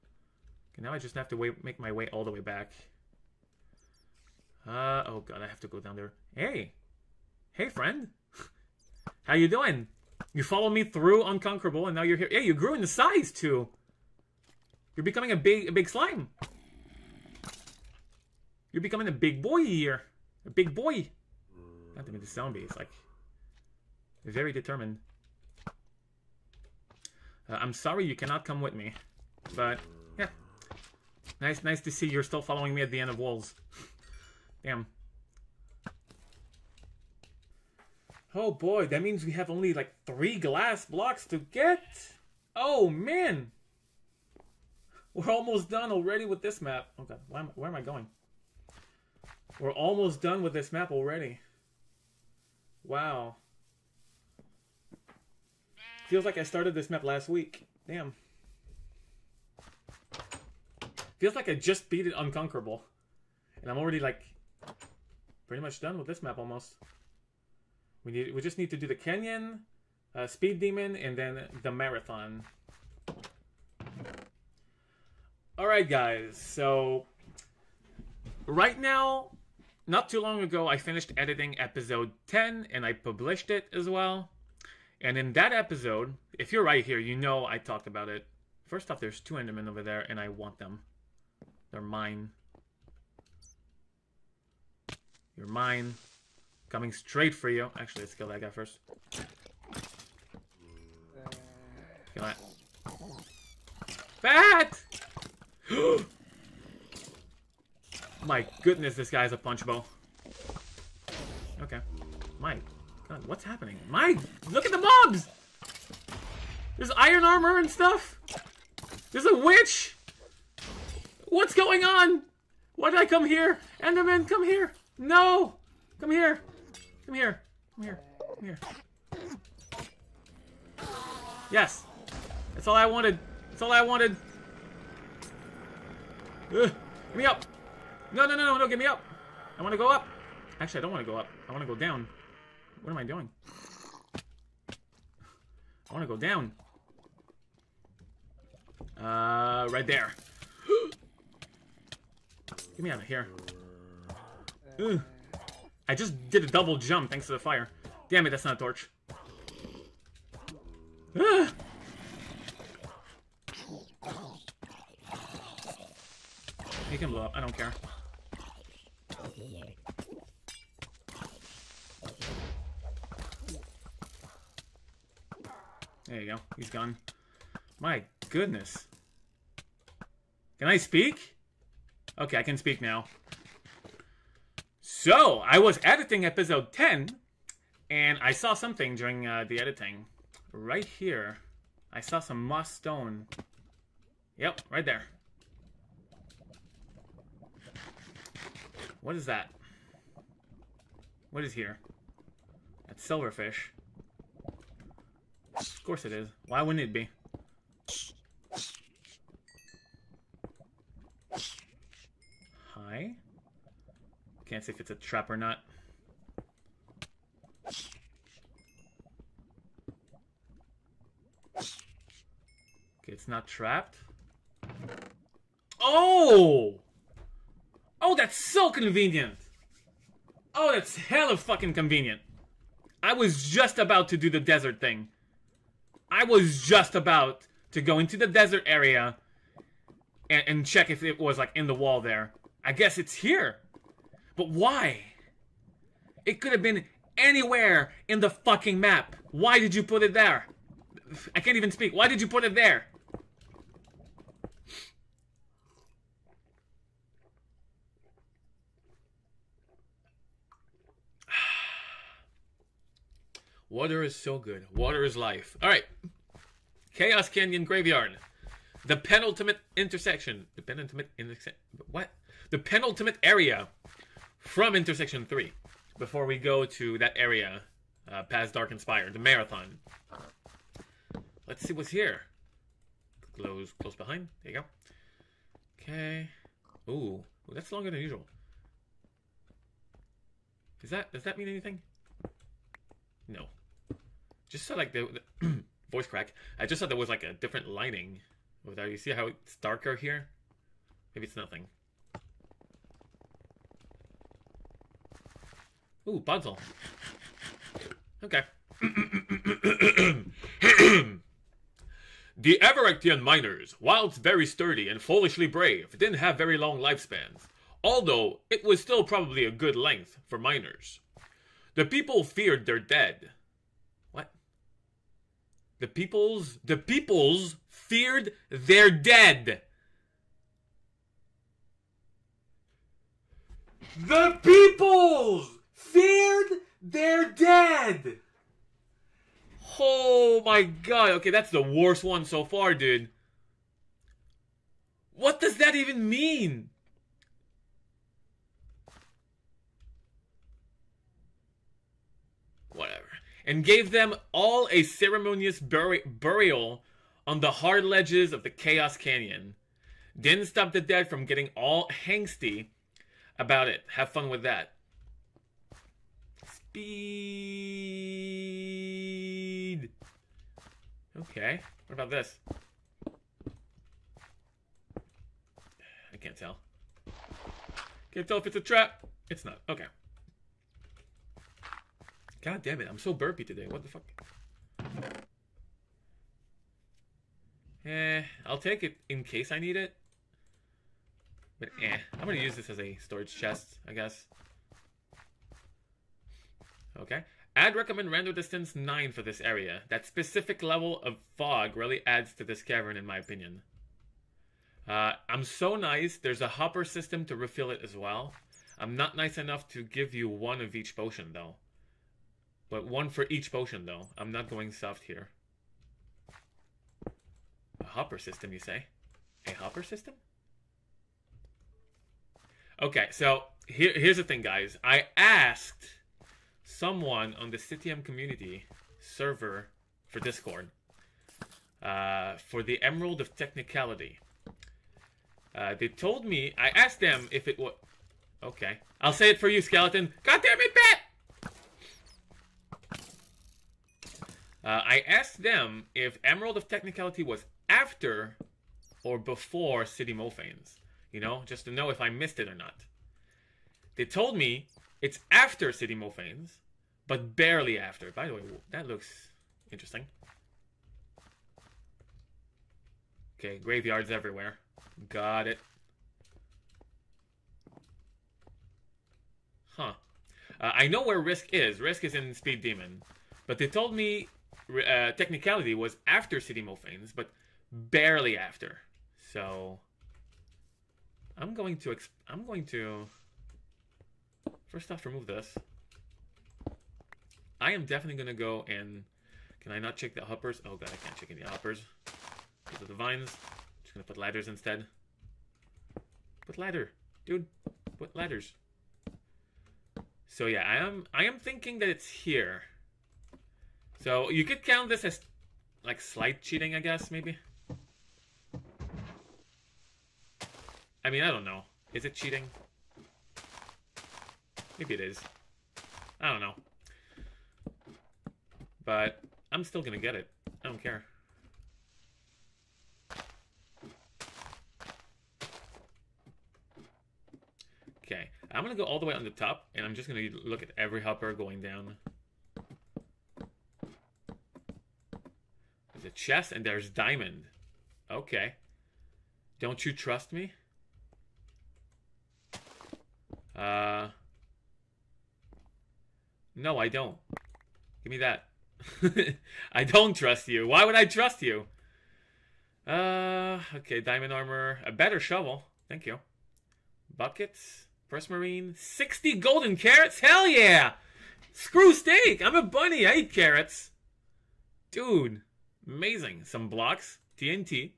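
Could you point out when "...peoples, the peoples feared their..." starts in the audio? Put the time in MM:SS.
05:25.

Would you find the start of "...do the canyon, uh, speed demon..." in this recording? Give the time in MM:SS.
01:08.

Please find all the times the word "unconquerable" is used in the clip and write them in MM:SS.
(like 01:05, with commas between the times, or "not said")
00:11, 01:02.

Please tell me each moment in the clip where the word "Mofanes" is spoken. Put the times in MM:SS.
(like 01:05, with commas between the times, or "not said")
07:30, 07:35.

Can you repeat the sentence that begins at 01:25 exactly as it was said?
And in that episode, if you're right here, you know I talked about it.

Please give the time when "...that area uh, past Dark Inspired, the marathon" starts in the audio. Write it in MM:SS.
04:36.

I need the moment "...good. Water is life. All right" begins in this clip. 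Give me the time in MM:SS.
04:24.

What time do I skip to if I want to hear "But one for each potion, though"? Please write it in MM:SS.
06:52.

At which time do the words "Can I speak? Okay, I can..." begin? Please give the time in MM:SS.
03:00.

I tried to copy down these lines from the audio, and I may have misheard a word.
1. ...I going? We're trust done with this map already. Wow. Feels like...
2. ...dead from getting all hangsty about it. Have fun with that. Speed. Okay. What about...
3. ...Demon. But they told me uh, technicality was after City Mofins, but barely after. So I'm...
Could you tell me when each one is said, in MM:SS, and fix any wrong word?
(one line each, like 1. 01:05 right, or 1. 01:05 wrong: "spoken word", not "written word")
1. 00:47 wrong: "almost", not "trust"
2. 06:00 right
3. 07:52 right.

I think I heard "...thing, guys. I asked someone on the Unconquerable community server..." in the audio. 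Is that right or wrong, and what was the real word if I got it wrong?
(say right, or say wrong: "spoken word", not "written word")
wrong: "CTM", not "Unconquerable".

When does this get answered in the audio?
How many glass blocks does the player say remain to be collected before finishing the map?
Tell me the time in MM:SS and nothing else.
00:40.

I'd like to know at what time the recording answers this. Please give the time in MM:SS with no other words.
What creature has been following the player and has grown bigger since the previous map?
00:15.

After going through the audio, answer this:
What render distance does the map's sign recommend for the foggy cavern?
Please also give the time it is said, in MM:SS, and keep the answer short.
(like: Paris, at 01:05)
9, at 06:38.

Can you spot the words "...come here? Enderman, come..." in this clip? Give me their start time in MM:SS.
02:03.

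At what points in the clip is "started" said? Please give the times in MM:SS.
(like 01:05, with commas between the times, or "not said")
00:56.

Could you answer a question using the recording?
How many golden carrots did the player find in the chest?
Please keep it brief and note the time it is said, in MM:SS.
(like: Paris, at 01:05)
60, at 09:18.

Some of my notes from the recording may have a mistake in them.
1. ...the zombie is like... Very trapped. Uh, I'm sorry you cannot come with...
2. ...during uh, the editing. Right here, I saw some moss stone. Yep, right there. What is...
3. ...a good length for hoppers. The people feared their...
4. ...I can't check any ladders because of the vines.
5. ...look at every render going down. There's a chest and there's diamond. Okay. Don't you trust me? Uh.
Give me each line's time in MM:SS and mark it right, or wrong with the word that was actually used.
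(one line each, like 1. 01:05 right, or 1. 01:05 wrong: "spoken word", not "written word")
1. 00:22 wrong: "determined", not "trapped"
2. 03:08 right
3. 05:19 wrong: "miners", not "hoppers"
4. 08:10 wrong: "hoppers", not "ladders"
5. 08:50 wrong: "hopper", not "render".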